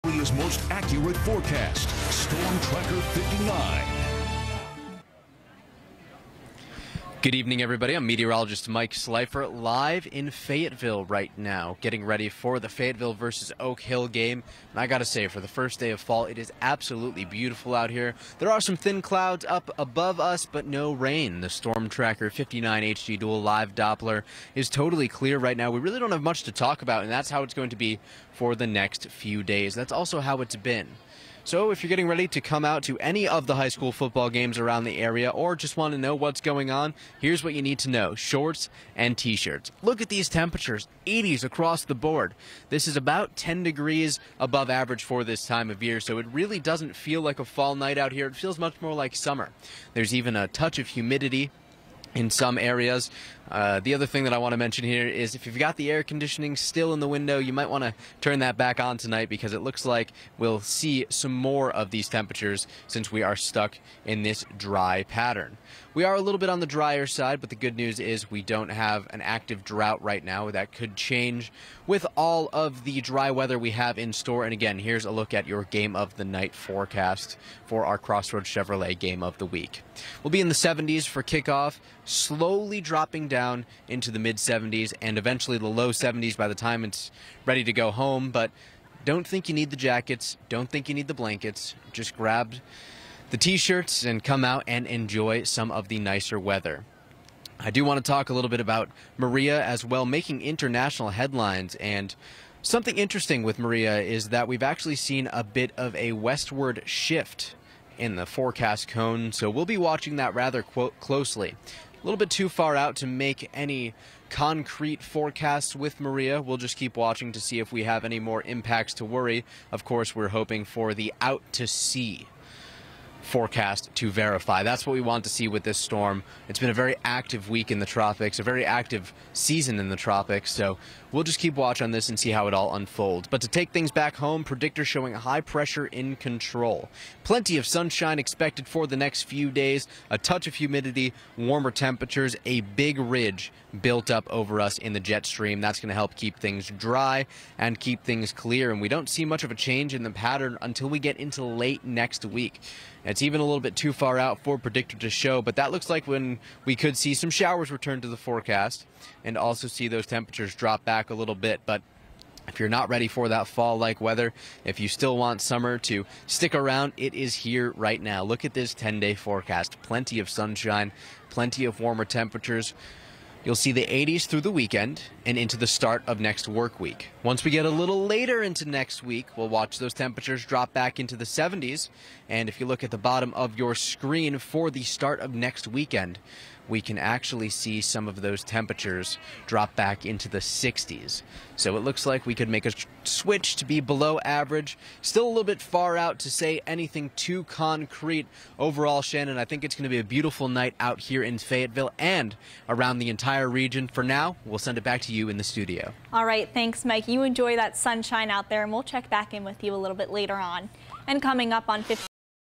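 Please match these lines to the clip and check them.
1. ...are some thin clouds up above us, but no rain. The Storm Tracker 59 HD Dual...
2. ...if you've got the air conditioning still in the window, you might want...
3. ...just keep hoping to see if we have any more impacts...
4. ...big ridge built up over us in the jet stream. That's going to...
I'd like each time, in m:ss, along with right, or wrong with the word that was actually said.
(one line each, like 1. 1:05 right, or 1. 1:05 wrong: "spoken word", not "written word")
1. 0:18 right
2. 0:55 right
3. 1:56 wrong: "watching", not "hoping"
4. 2:22 right.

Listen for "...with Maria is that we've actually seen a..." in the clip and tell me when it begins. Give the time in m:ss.
1:43.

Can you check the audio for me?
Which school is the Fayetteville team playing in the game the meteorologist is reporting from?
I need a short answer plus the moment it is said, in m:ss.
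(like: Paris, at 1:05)
Oak Hill, at 0:13.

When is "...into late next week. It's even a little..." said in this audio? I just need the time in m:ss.
2:31.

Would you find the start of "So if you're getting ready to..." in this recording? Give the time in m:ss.
0:31.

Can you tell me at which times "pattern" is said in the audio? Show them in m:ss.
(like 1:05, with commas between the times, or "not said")
1:05, 2:30.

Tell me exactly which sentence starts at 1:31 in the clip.
Just grab the t shirts and come out and enjoy some of the nicer weather.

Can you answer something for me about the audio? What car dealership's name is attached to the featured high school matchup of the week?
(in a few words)
Crossroads Chevrolet.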